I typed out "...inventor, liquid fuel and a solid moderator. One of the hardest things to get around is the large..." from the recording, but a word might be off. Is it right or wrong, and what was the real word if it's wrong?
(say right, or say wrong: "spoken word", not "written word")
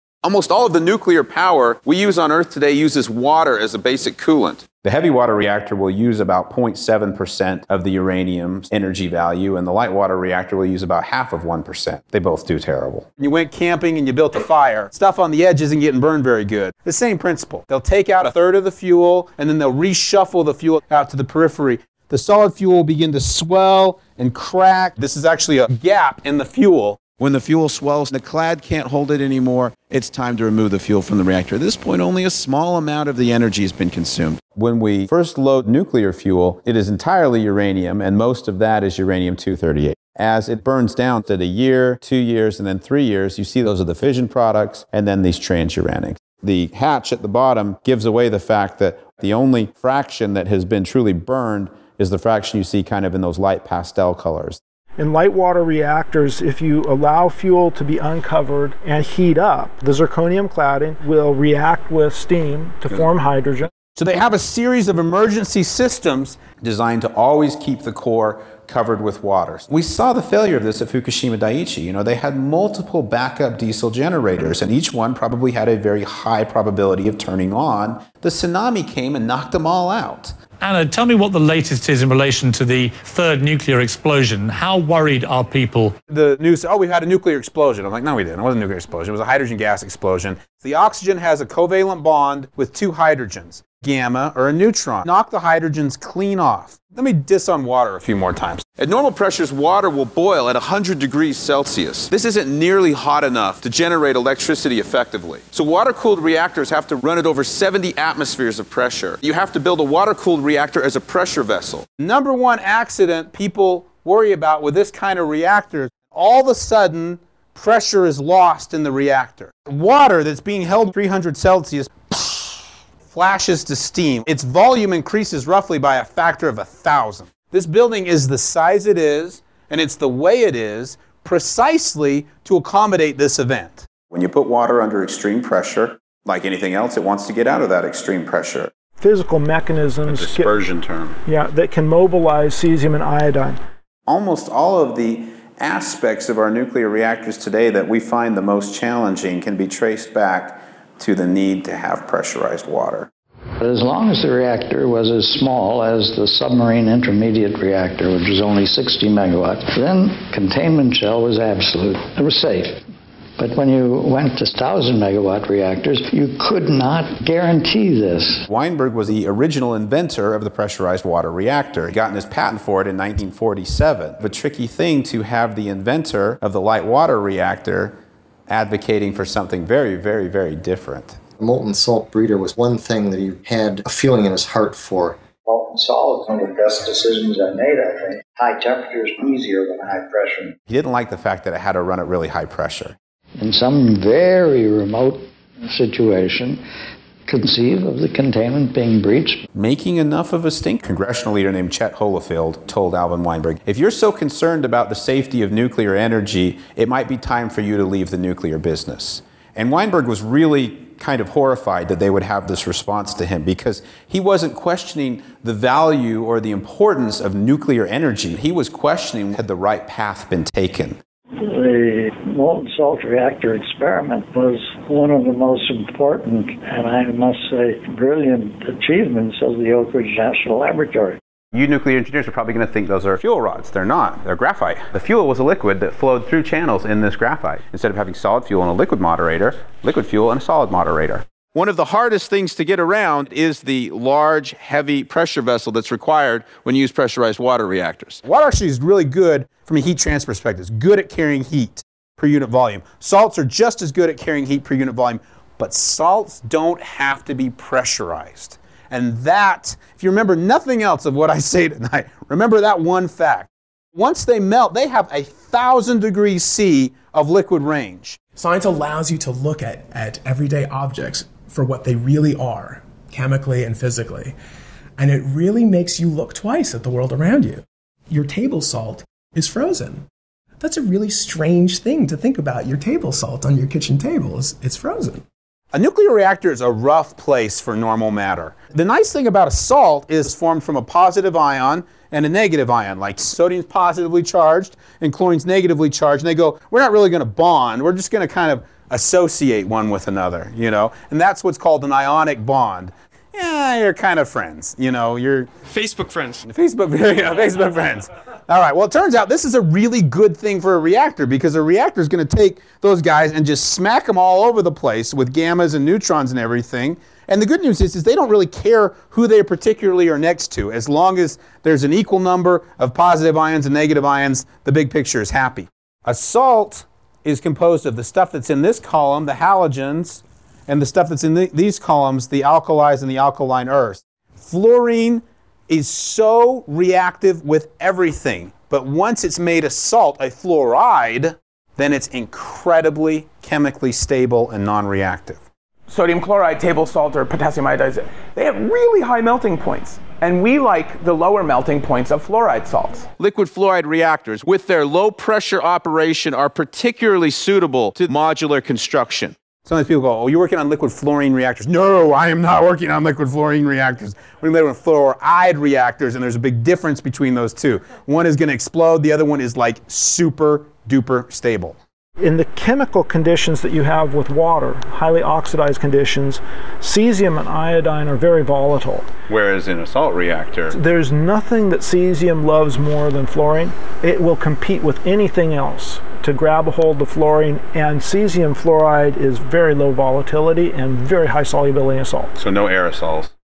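wrong: "moderator", not "inventor".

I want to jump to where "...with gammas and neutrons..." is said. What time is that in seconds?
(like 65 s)
315 s.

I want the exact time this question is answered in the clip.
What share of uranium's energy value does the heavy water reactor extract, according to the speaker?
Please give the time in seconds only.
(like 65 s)
6 s.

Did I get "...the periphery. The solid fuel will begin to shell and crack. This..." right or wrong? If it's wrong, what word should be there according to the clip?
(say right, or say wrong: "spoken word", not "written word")
wrong: "swell", not "shell".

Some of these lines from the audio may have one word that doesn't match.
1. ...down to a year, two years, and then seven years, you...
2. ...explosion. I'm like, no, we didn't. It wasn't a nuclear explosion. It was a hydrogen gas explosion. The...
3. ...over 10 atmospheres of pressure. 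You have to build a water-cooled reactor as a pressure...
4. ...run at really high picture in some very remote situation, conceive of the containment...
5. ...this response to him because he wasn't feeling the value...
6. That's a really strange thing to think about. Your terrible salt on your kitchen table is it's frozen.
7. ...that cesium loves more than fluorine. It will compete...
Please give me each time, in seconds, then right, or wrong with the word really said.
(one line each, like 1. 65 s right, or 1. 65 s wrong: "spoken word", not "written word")
1. 40 s wrong: "three", not "seven"
2. 87 s right
3. 107 s wrong: "70", not "10"
4. 191 s wrong: "pressure", not "picture"
5. 212 s wrong: "questioning", not "feeling"
6. 280 s wrong: "table", not "terrible"
7. 381 s right.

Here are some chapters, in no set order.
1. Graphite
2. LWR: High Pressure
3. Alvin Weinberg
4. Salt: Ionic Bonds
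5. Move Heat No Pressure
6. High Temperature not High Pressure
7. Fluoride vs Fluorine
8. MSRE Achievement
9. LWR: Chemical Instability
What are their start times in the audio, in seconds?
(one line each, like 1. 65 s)
1. 231 s
2. 98 s
3. 168 s
4. 285 s
5. 248 s
6. 185 s
7. 333 s
8. 220 s
9. 54 s.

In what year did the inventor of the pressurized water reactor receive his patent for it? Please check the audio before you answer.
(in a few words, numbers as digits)
1947.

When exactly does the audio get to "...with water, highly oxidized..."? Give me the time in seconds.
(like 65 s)
374 s.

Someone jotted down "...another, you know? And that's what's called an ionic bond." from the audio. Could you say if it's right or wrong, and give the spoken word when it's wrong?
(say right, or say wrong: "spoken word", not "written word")
right.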